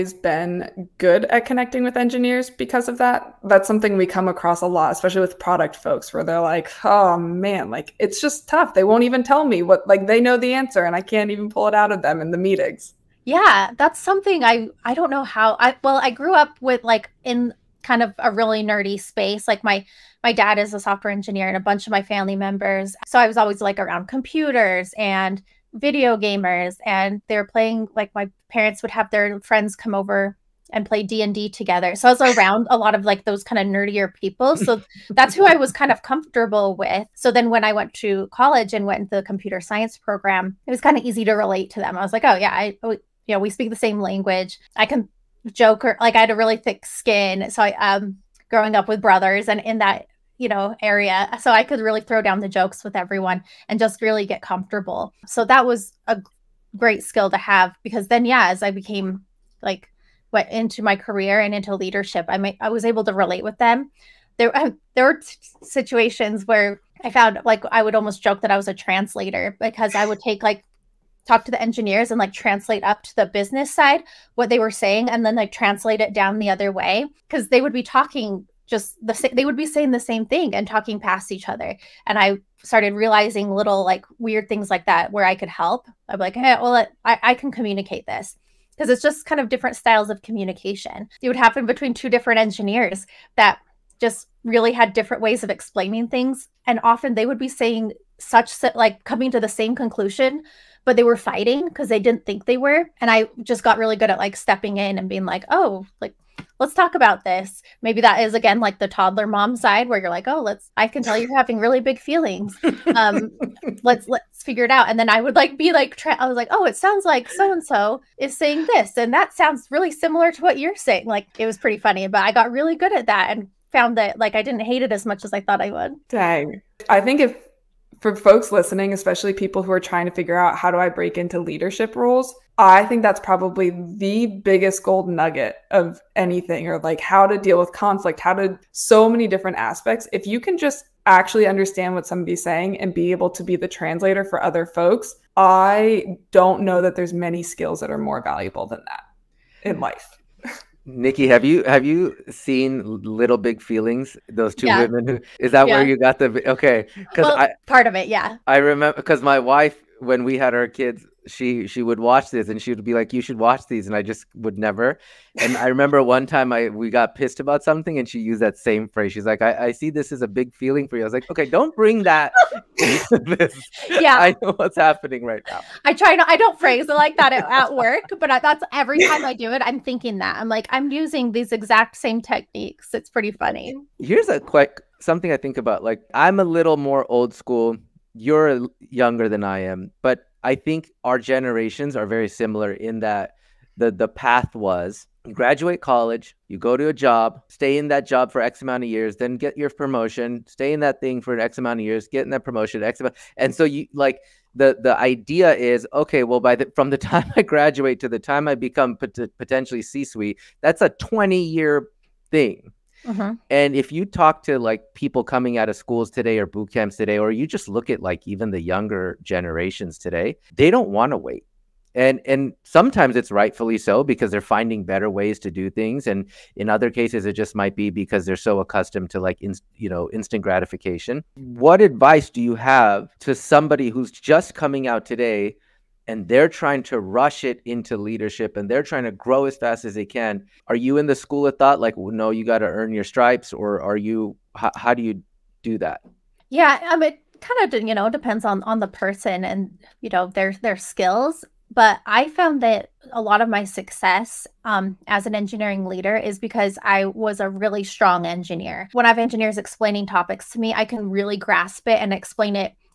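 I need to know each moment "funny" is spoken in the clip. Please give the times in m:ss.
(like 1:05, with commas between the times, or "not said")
2:01, 3:03.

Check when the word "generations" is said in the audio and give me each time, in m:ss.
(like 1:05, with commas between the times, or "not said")
3:11, 3:39.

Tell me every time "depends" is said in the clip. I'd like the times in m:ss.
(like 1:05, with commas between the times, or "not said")
4:08.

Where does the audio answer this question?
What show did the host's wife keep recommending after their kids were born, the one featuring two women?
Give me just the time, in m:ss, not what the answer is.
2:33.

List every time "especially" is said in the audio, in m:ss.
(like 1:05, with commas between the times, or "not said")
0:04, 2:08.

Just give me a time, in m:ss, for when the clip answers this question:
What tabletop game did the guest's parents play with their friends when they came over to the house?
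0:31.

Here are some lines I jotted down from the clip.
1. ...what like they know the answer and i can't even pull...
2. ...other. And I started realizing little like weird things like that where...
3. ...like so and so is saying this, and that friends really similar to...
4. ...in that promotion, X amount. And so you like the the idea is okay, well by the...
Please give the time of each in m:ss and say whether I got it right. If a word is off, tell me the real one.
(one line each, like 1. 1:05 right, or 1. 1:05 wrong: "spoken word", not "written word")
1. 0:09 right
2. 1:21 right
3. 1:57 wrong: "sounds", not "friends"
4. 3:22 right.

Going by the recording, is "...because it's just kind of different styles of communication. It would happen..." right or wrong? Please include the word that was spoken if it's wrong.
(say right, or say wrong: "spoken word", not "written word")
right.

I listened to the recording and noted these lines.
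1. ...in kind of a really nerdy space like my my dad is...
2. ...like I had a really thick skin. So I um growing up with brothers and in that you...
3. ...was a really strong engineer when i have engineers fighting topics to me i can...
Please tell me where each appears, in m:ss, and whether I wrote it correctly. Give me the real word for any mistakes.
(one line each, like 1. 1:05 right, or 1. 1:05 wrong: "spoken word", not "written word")
1. 0:17 right
2. 0:45 right
3. 4:17 wrong: "explaining", not "fighting".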